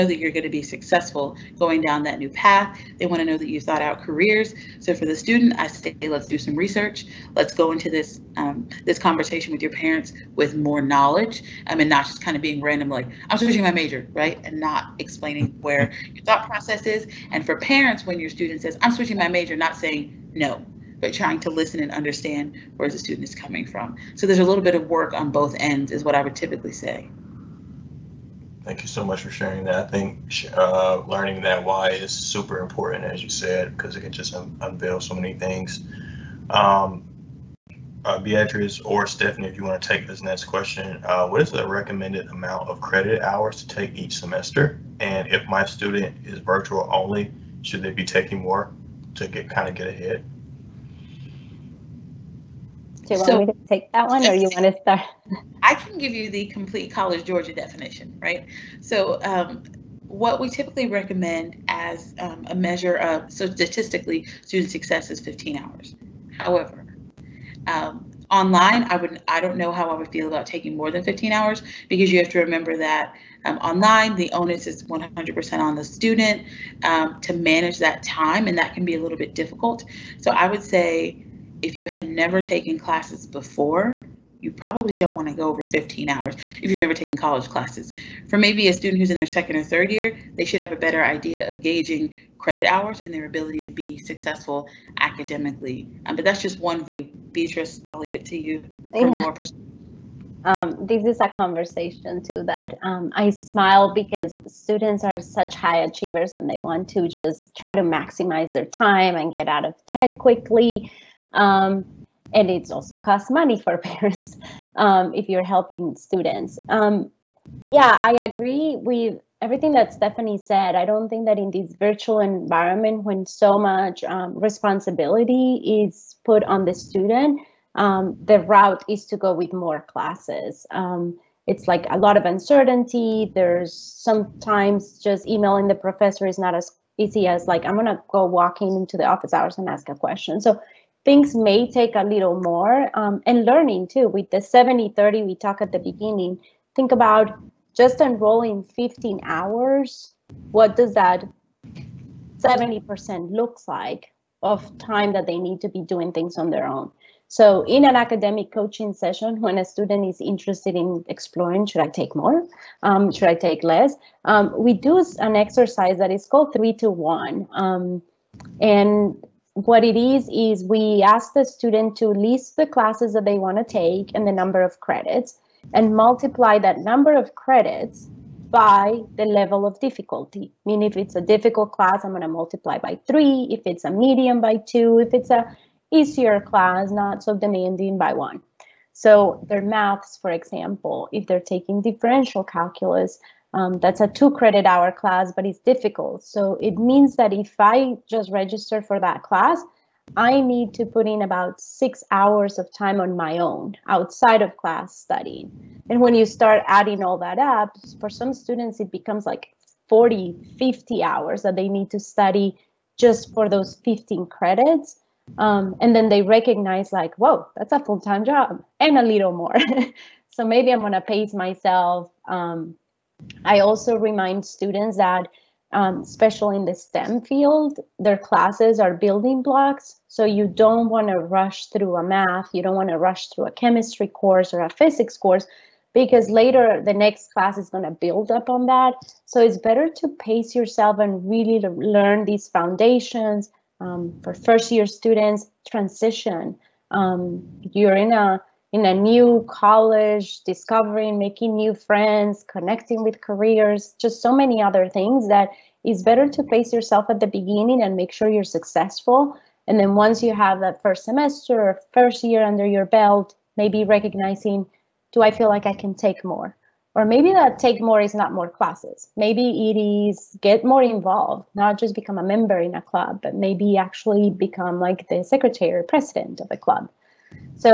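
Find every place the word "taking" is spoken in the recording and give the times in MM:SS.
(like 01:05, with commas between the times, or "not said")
00:48, 01:10, 03:11.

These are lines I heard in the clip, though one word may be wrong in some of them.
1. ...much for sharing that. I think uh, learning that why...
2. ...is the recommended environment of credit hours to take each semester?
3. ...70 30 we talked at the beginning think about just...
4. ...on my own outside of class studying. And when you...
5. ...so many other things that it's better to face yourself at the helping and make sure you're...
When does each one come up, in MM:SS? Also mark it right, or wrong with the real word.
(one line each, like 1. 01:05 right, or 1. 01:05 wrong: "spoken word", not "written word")
1. 00:29 right
2. 00:41 wrong: "amount", not "environment"
3. 02:24 right
4. 03:22 right
5. 04:14 wrong: "beginning", not "helping".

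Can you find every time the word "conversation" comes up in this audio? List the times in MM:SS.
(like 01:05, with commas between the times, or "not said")
00:08, 01:41.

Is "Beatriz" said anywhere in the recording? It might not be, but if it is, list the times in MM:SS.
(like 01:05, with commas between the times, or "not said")
00:38, 01:37.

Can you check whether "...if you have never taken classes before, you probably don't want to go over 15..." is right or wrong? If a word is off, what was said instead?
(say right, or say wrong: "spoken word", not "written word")
right.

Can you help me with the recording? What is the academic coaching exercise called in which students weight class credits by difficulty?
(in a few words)
three to one.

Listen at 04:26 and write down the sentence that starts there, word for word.
Or maybe that take more is not more classes.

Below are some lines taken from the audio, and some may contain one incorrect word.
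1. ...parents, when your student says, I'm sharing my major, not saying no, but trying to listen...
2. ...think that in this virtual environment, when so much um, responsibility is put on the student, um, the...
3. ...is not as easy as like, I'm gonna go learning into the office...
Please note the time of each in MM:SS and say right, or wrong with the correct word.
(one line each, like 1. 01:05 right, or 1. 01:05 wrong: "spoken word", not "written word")
1. 00:17 wrong: "switching", not "sharing"
2. 02:01 right
3. 02:16 wrong: "walking", not "learning".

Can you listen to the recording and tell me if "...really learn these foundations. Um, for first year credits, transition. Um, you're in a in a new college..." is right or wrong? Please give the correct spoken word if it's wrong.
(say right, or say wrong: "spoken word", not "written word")
wrong: "students", not "credits".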